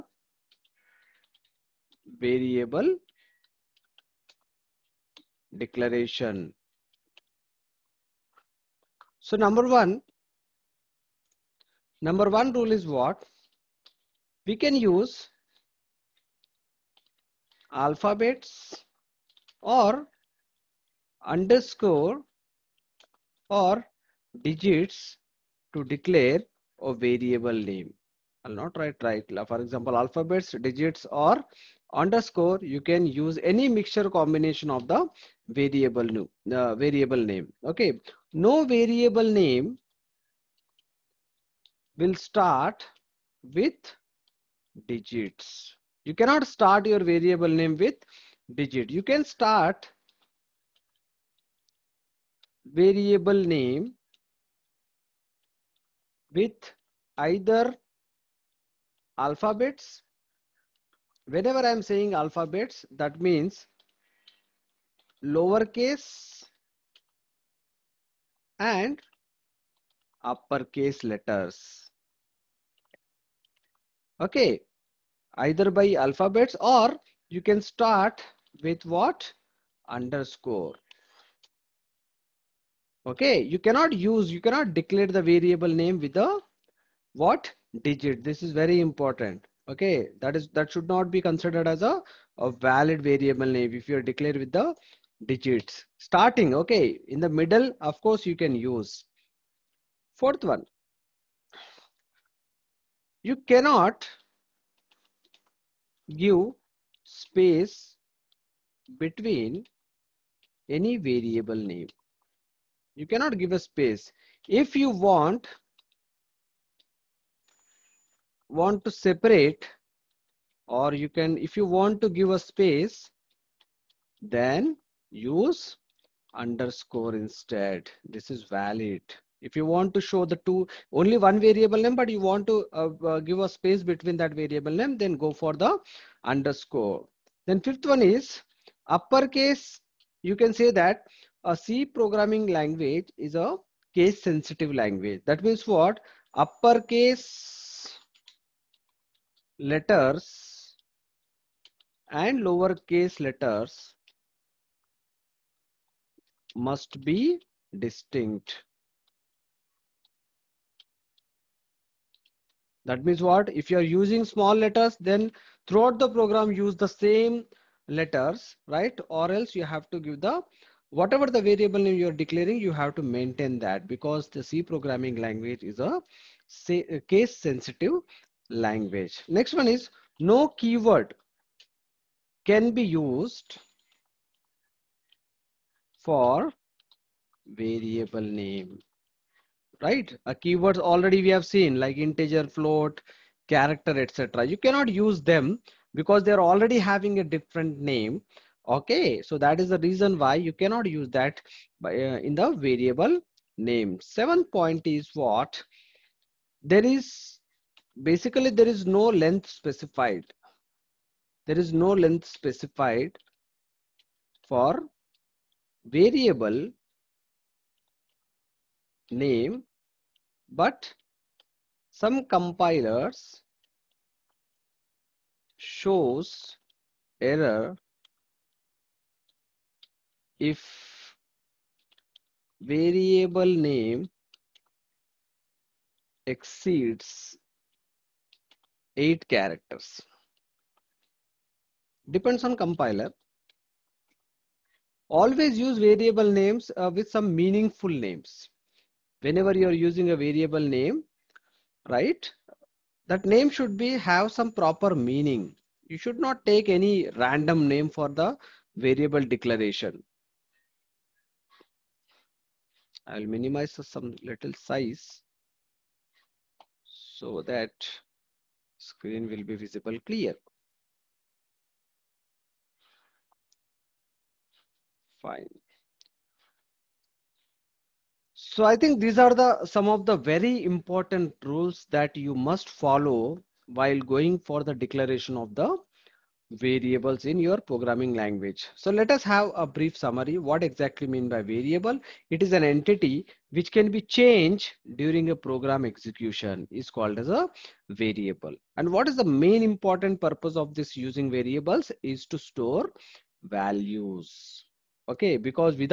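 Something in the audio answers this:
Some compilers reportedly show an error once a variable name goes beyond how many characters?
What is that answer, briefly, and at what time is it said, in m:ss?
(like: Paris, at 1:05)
8, at 3:58.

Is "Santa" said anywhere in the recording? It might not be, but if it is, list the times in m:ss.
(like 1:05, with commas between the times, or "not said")
not said.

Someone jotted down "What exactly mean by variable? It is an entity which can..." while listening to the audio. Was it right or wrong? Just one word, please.
right.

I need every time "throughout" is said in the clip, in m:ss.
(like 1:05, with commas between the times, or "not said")
2:45.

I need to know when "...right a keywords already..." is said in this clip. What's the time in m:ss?
3:09.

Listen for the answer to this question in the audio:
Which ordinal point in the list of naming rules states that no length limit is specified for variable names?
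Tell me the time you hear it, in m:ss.
3:24.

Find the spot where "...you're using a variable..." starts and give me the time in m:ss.
4:09.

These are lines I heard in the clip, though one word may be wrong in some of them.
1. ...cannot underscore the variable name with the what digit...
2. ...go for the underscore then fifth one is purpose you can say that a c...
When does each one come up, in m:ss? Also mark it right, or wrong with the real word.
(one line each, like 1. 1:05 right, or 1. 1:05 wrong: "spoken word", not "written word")
1. 1:24 wrong: "declare", not "underscore"
2. 2:15 wrong: "uppercase", not "purpose".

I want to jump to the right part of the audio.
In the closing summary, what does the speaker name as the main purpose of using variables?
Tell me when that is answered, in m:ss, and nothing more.
5:02.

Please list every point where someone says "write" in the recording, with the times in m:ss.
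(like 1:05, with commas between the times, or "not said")
0:28.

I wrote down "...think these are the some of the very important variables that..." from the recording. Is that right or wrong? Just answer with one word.
wrong.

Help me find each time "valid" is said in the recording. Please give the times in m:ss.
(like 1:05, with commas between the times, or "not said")
1:32, 2:08.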